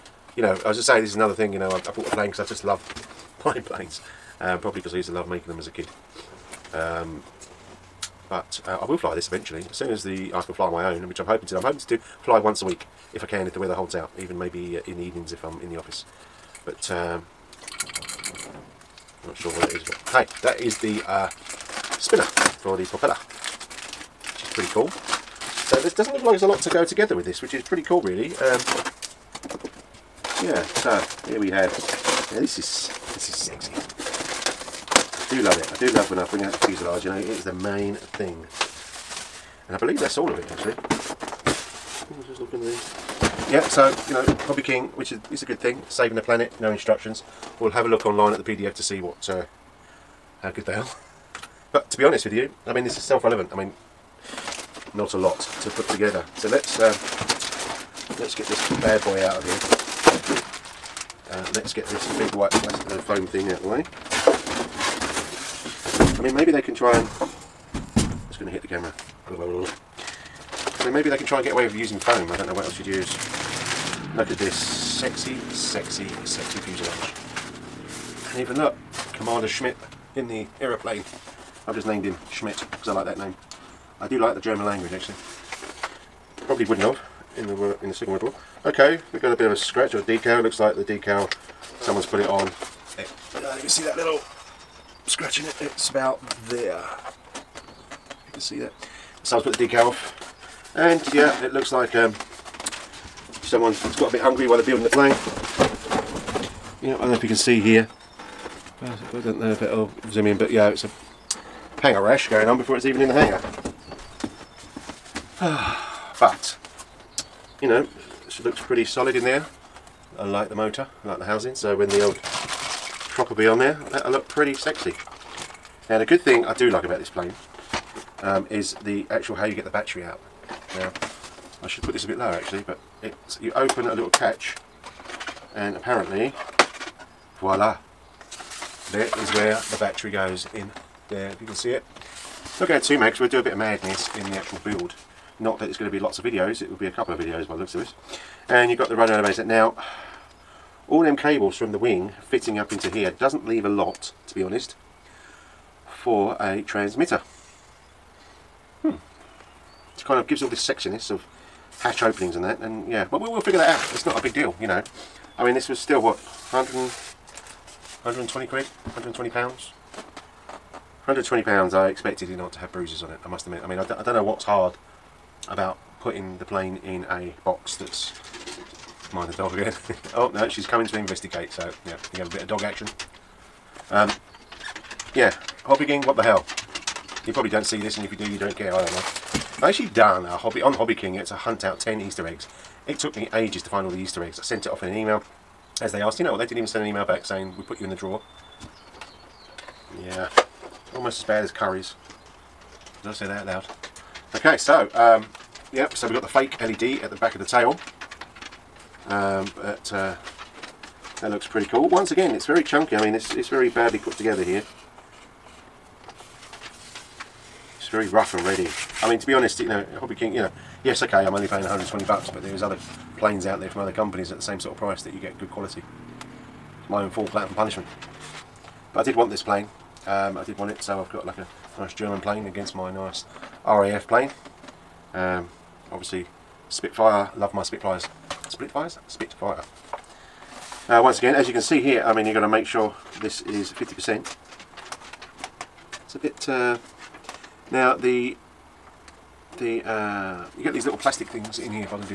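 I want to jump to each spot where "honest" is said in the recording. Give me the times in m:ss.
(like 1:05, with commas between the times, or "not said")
0:52, 2:34, 3:39.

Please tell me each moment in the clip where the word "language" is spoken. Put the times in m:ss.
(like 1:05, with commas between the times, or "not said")
1:24.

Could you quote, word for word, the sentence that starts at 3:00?
oh no, she's coming to investigate.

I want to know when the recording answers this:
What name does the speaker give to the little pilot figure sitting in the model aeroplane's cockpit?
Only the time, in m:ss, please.
1:19.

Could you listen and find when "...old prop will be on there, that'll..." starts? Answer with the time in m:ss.
2:02.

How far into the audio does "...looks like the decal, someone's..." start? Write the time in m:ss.
1:30.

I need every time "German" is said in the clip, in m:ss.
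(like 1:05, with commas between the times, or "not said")
1:24, 3:51.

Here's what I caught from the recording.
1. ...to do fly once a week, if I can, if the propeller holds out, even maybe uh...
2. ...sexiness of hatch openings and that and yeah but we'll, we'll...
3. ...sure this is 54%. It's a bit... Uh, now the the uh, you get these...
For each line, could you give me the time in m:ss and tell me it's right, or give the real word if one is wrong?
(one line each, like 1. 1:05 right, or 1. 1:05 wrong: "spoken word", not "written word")
1. 0:11 wrong: "weather", not "propeller"
2. 2:40 right
3. 4:02 wrong: "50", not "54".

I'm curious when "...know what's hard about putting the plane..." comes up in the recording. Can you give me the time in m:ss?
2:54.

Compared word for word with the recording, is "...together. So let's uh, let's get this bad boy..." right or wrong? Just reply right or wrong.
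right.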